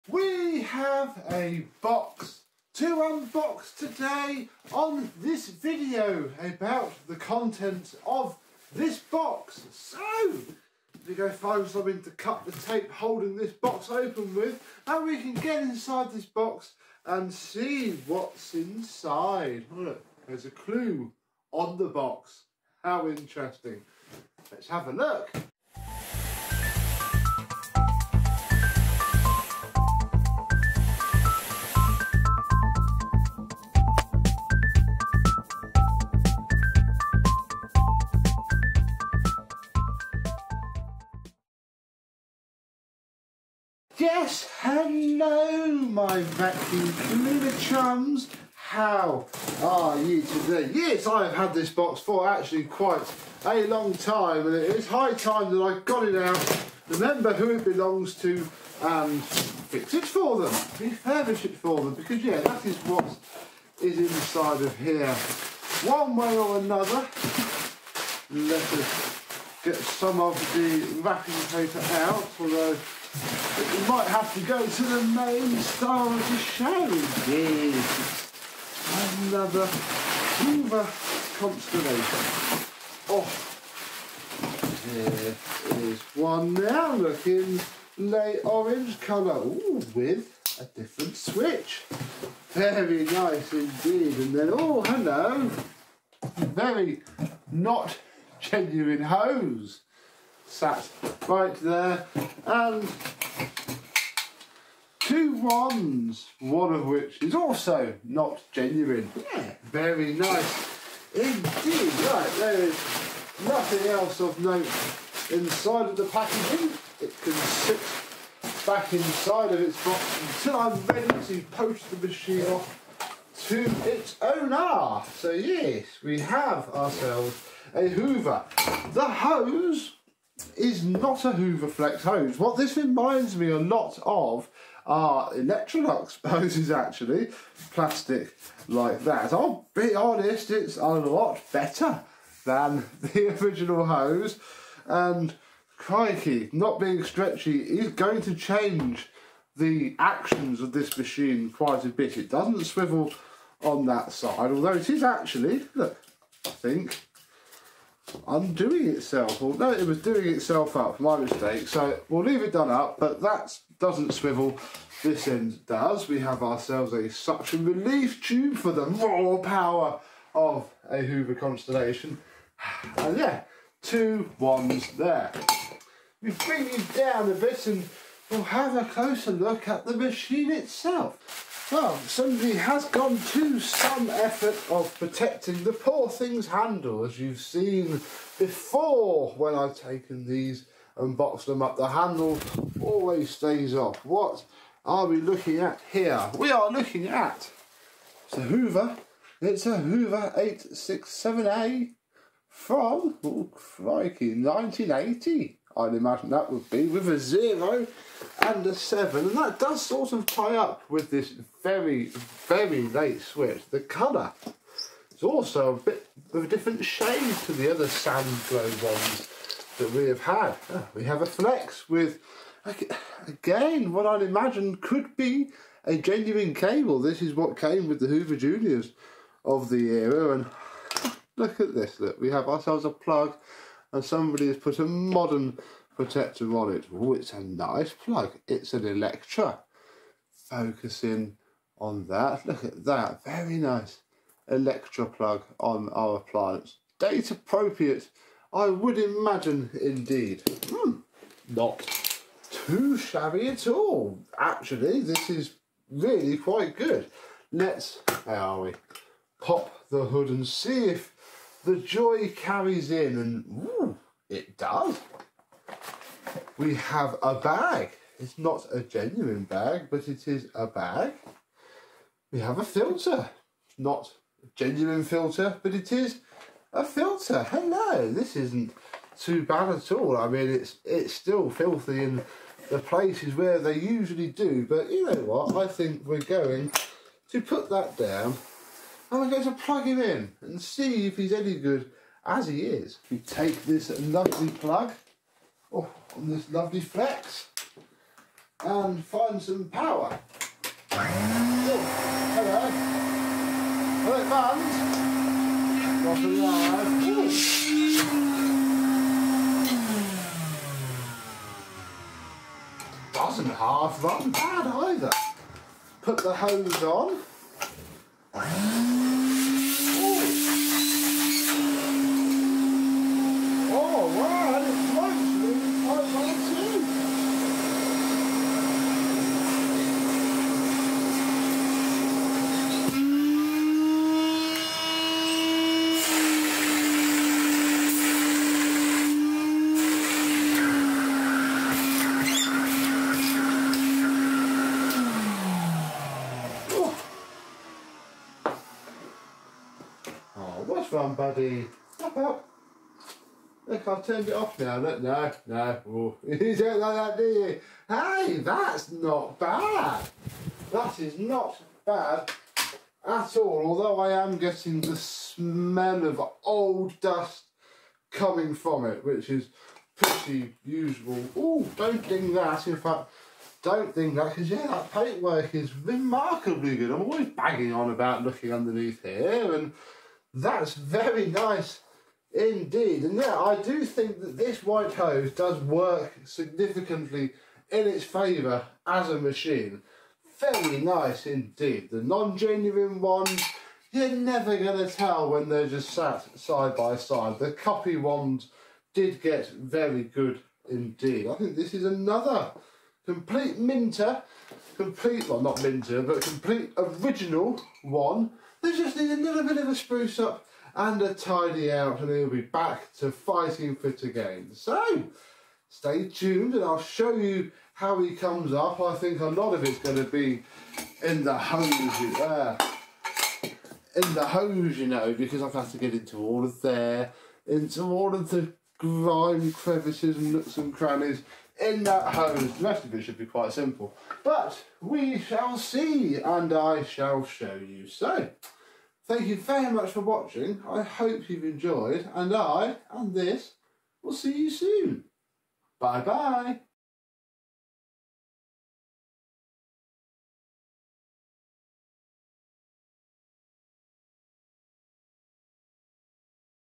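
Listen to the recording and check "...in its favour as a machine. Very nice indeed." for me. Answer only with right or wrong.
right.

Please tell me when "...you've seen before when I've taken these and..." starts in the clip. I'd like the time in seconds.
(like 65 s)
187 s.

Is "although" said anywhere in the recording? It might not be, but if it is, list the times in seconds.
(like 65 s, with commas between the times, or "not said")
72 s, 154 s, 363 s.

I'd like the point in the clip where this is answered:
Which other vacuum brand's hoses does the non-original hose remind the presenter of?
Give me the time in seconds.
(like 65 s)
135 s.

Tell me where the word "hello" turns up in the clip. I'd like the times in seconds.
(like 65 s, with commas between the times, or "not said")
44 s, 94 s, 277 s, 302 s.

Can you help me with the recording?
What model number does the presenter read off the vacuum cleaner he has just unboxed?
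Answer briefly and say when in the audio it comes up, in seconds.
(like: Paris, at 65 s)
867A, at 200 s.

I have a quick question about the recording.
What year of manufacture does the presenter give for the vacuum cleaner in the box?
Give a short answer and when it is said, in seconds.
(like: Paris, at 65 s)
1980, at 204 s.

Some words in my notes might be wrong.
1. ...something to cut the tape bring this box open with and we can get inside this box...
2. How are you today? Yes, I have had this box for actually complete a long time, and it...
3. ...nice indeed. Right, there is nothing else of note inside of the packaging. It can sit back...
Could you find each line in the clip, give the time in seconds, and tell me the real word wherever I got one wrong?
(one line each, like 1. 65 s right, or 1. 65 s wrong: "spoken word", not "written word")
1. 11 s wrong: "holding", not "bring"
2. 48 s wrong: "quite", not "complete"
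3. 110 s right.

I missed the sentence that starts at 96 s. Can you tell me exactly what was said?
Very not genuine hose sat right there.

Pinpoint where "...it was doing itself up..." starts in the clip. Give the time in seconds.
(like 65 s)
159 s.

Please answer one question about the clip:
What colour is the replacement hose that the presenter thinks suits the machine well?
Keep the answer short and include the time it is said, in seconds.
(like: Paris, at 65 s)
White, at 384 s.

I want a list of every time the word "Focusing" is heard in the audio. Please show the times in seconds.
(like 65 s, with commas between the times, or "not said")
240 s.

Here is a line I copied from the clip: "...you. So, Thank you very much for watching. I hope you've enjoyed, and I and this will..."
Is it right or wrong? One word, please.
right.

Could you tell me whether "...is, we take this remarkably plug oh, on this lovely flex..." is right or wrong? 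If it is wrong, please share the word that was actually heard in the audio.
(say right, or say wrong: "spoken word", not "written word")
wrong: "lovely", not "remarkably".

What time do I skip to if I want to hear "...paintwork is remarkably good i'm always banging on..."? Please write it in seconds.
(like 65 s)
374 s.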